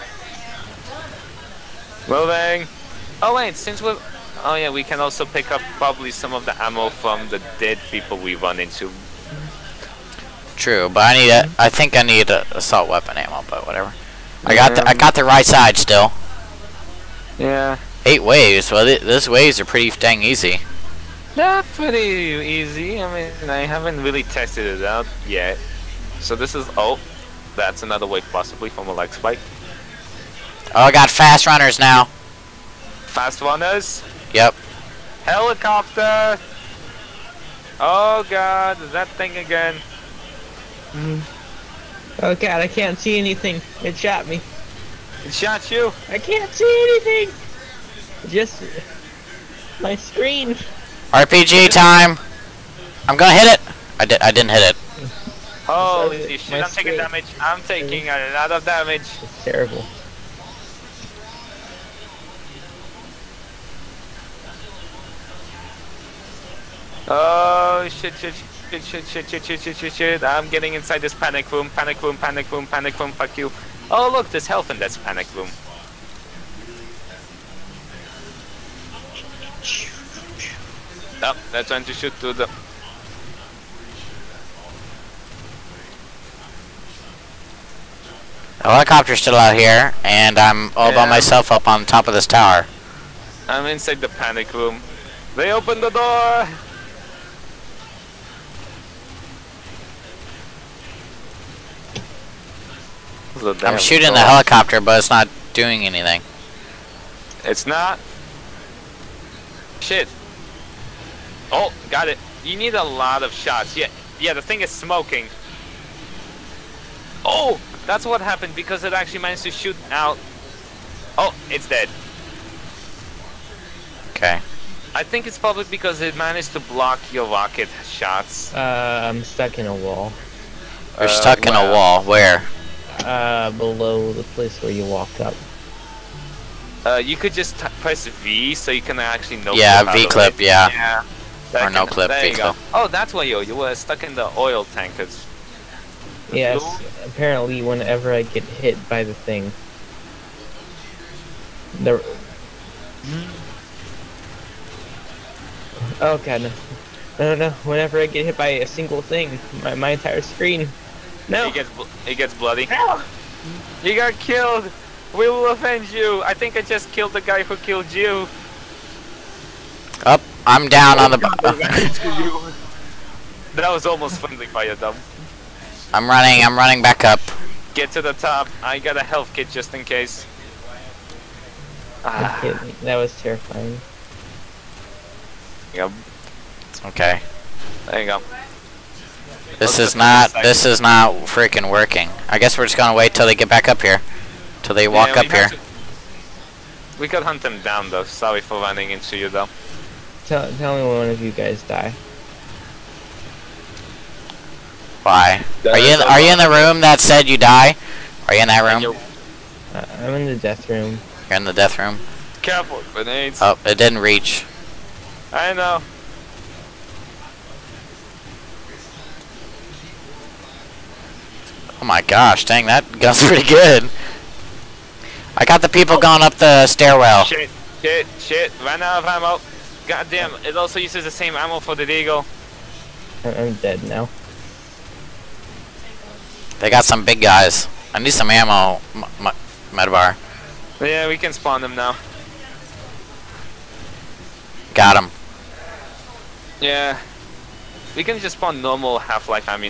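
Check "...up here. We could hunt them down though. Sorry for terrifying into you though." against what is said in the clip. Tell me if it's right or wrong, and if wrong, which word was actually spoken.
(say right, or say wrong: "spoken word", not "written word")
wrong: "running", not "terrifying".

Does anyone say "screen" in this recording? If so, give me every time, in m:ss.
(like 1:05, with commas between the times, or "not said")
0:49, 2:40.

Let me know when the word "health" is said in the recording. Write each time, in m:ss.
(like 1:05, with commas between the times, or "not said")
1:14, 2:59.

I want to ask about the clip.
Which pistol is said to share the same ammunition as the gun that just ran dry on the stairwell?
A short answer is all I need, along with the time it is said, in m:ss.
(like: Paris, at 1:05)
Deagle, at 3:51.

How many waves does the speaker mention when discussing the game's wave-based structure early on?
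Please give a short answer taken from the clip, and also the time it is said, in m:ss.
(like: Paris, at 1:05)
8, at 0:18.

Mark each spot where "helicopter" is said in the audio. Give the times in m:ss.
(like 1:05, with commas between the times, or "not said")
0:35, 1:28, 1:44.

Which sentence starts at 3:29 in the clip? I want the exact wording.
Uh, I'm in the death room.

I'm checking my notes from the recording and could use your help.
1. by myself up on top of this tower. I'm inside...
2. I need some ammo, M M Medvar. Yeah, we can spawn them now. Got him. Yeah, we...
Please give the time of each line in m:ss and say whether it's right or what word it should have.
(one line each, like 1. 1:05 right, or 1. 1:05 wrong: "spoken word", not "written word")
1. 1:31 right
2. 3:57 right.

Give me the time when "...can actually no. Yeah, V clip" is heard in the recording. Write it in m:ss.
2:18.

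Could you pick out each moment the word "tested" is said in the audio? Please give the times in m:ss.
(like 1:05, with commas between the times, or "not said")
0:24.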